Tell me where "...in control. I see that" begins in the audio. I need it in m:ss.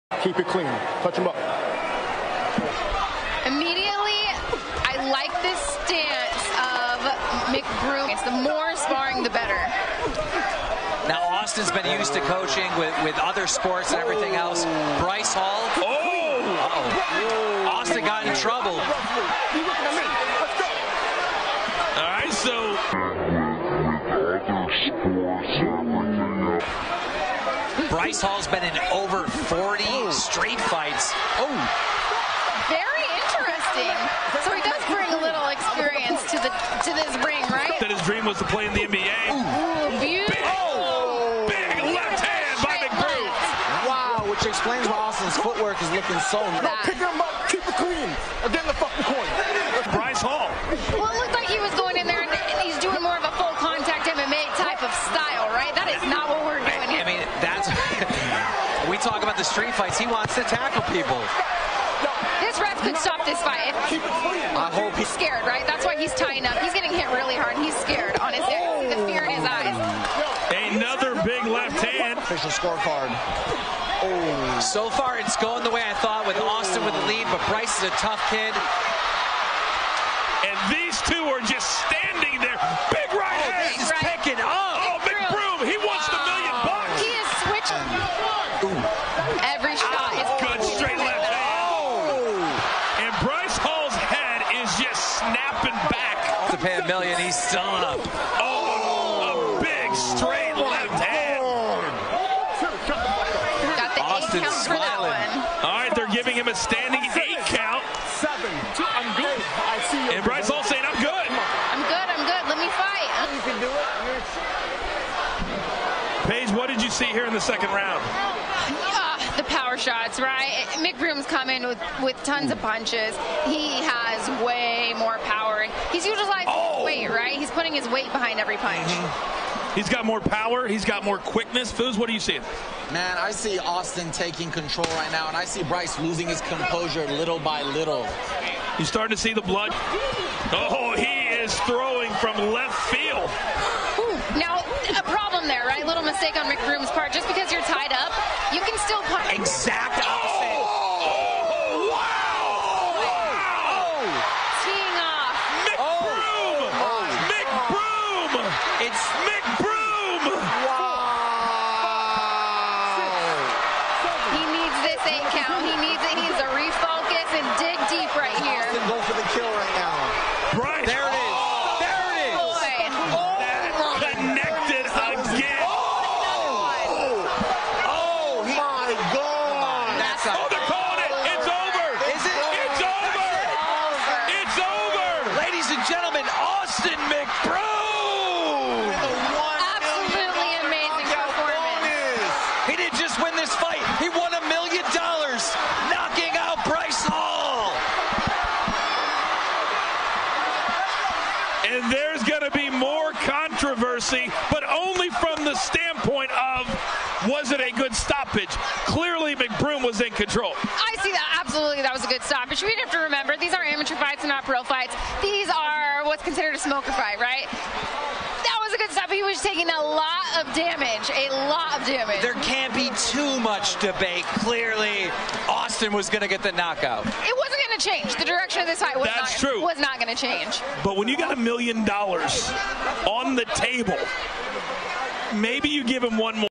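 3:30.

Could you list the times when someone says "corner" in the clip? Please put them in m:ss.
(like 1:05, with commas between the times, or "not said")
0:49.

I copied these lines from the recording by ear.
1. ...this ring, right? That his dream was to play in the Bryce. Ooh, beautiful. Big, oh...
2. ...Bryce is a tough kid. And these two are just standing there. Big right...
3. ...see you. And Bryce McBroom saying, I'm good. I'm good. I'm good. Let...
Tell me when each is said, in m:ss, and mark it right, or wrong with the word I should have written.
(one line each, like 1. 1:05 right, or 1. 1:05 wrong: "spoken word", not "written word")
1. 0:36 wrong: "NBA", not "Bryce"
2. 1:17 right
3. 1:49 wrong: "Hall", not "McBroom".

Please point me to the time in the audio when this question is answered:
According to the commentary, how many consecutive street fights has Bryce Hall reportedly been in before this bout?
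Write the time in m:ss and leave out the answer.
0:28.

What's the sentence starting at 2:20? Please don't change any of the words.
Oh, he is throwing from left field.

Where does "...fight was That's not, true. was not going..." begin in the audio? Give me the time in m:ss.
3:48.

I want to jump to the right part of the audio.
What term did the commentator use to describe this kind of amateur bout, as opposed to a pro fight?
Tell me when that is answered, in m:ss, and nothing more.
3:36.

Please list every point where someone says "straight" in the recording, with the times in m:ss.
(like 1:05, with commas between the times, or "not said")
0:30, 1:30, 1:39.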